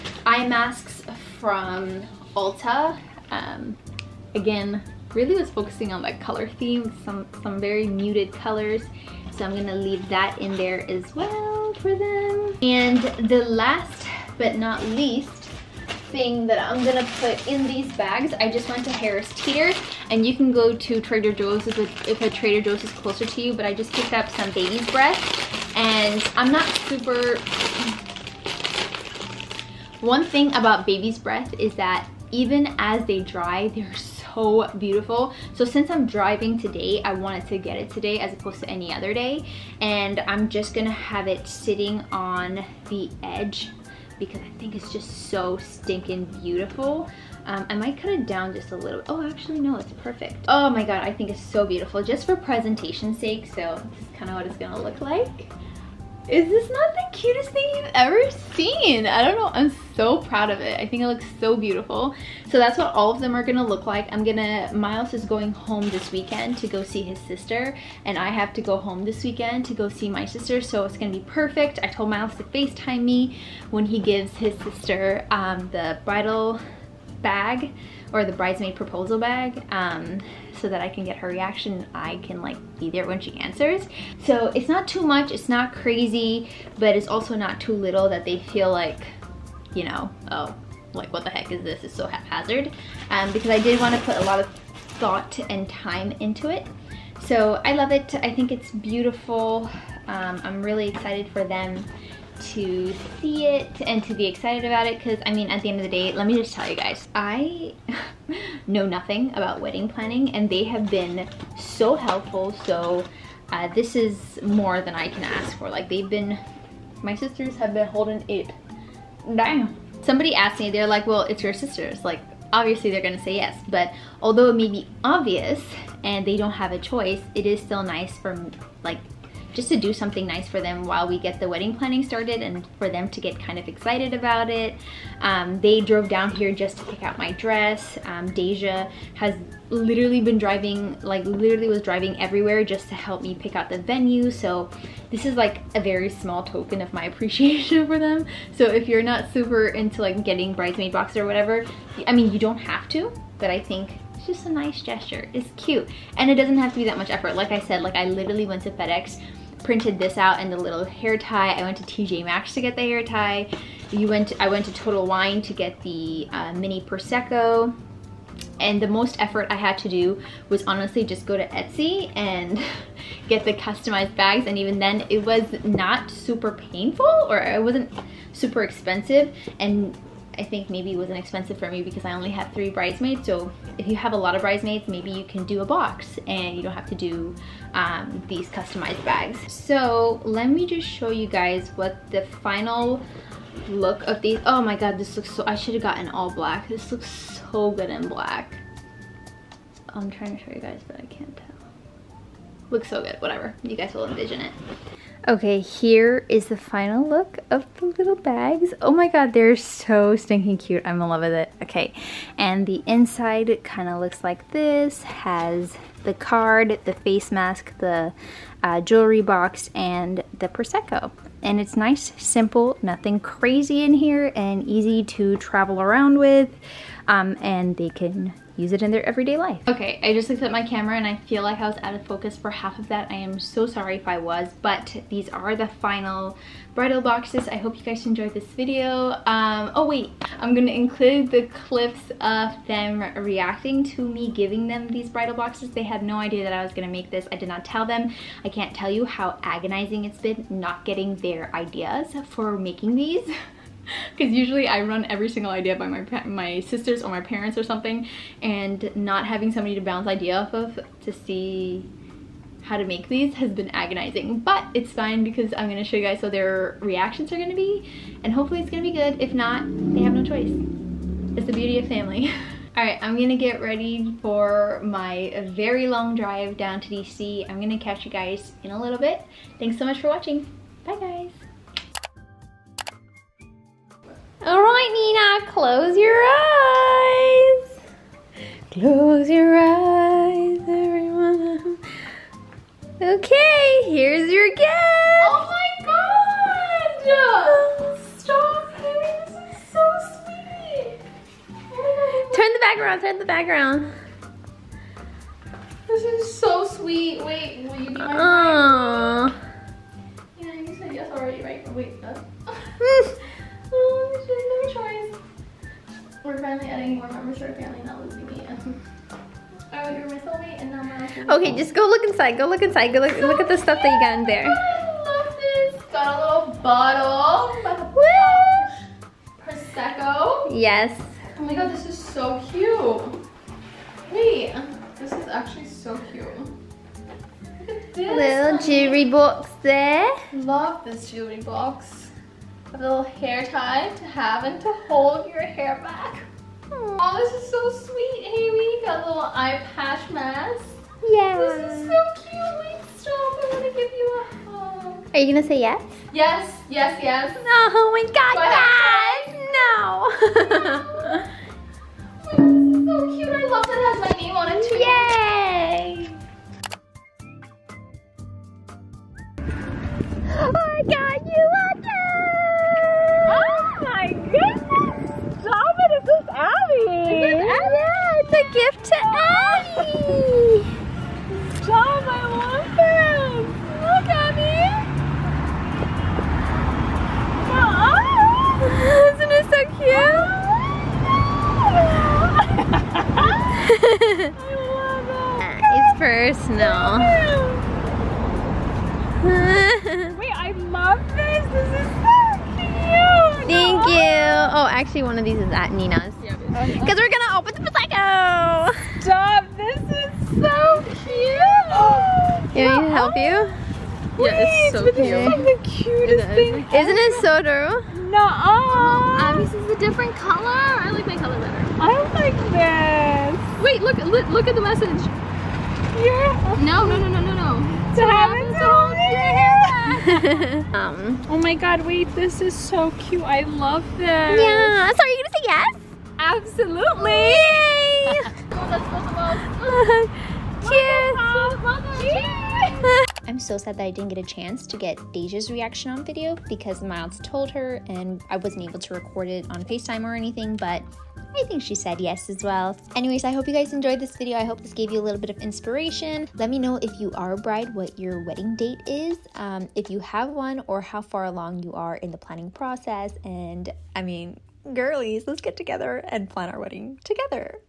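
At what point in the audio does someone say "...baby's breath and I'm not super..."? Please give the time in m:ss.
0:24.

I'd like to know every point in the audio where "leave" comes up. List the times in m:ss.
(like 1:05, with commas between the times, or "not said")
0:09.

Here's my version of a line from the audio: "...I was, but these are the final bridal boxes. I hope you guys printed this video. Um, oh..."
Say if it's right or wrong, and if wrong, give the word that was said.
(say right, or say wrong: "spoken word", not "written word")
wrong: "enjoyed", not "printed".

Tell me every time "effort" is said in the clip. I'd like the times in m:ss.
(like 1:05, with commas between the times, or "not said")
2:37, 2:49.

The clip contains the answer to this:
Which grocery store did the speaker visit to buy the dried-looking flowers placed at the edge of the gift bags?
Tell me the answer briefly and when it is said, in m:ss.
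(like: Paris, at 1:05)
Harris Teeter, at 0:18.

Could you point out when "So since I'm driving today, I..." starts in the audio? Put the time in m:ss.
0:35.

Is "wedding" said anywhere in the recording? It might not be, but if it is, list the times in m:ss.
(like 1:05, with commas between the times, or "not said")
1:49, 2:11, 7:38, 7:46.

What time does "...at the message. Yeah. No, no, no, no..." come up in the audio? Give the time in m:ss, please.
7:04.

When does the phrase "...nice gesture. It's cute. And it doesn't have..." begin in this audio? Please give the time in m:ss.
2:34.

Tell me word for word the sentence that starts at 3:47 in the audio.
Um, and they can use it in their everyday life.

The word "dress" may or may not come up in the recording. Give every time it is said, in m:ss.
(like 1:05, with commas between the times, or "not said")
2:17.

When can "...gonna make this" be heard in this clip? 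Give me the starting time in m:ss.
4:06.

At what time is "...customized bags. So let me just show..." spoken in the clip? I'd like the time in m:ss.
3:08.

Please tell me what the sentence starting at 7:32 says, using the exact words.
Anyways, I hope you guys enjoyed this video.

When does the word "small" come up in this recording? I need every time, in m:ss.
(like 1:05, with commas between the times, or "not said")
2:26.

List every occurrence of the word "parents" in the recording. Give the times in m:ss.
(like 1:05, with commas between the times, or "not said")
4:17.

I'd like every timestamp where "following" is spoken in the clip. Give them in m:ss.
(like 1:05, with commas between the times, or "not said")
not said.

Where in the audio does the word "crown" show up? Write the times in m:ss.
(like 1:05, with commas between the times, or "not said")
not said.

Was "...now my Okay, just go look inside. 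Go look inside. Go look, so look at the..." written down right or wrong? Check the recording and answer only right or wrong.
right.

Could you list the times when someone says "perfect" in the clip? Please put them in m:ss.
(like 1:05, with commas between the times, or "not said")
0:50, 1:11.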